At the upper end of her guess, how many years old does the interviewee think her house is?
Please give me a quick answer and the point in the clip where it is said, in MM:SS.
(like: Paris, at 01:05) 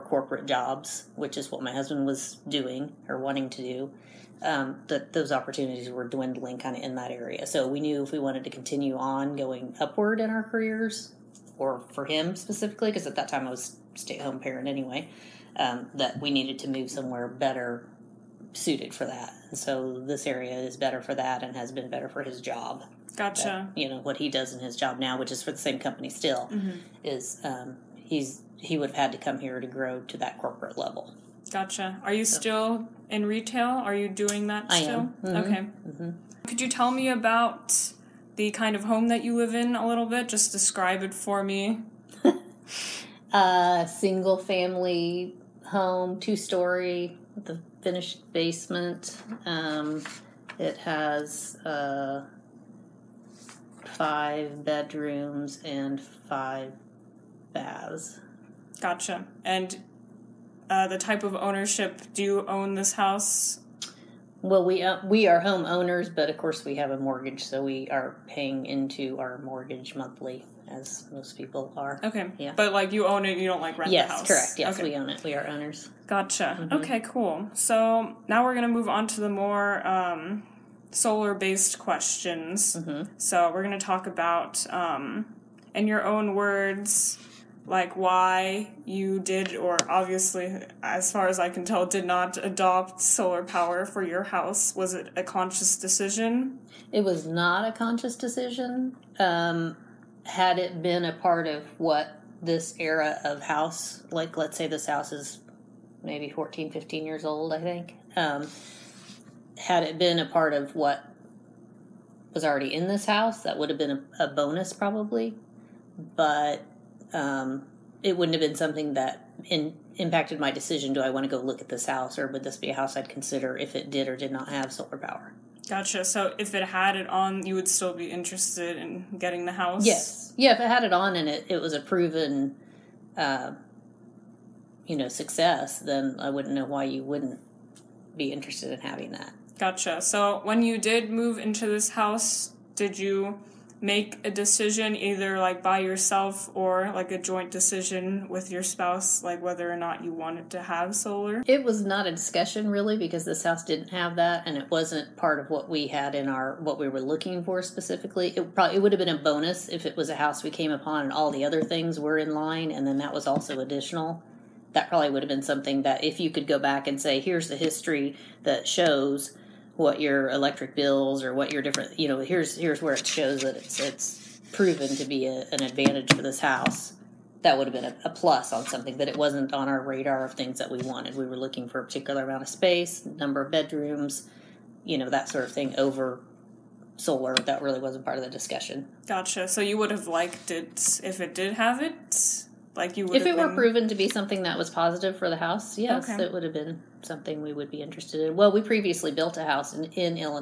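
15, at 01:46.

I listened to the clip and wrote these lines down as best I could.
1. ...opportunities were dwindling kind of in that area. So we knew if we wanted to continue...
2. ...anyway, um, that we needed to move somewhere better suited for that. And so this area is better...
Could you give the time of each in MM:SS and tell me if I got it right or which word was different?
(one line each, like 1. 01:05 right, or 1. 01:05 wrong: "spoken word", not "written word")
1. 00:05 right
2. 00:14 right.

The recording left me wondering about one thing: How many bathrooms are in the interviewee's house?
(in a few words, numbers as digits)
5.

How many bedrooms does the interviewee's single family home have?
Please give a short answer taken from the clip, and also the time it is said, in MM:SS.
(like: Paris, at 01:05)
5, at 00:53.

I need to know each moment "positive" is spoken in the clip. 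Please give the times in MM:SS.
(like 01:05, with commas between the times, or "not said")
03:14.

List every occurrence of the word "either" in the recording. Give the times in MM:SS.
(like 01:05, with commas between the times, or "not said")
02:24.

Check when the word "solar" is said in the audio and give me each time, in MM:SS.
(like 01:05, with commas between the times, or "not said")
01:20, 01:33, 02:04, 02:30, 03:06.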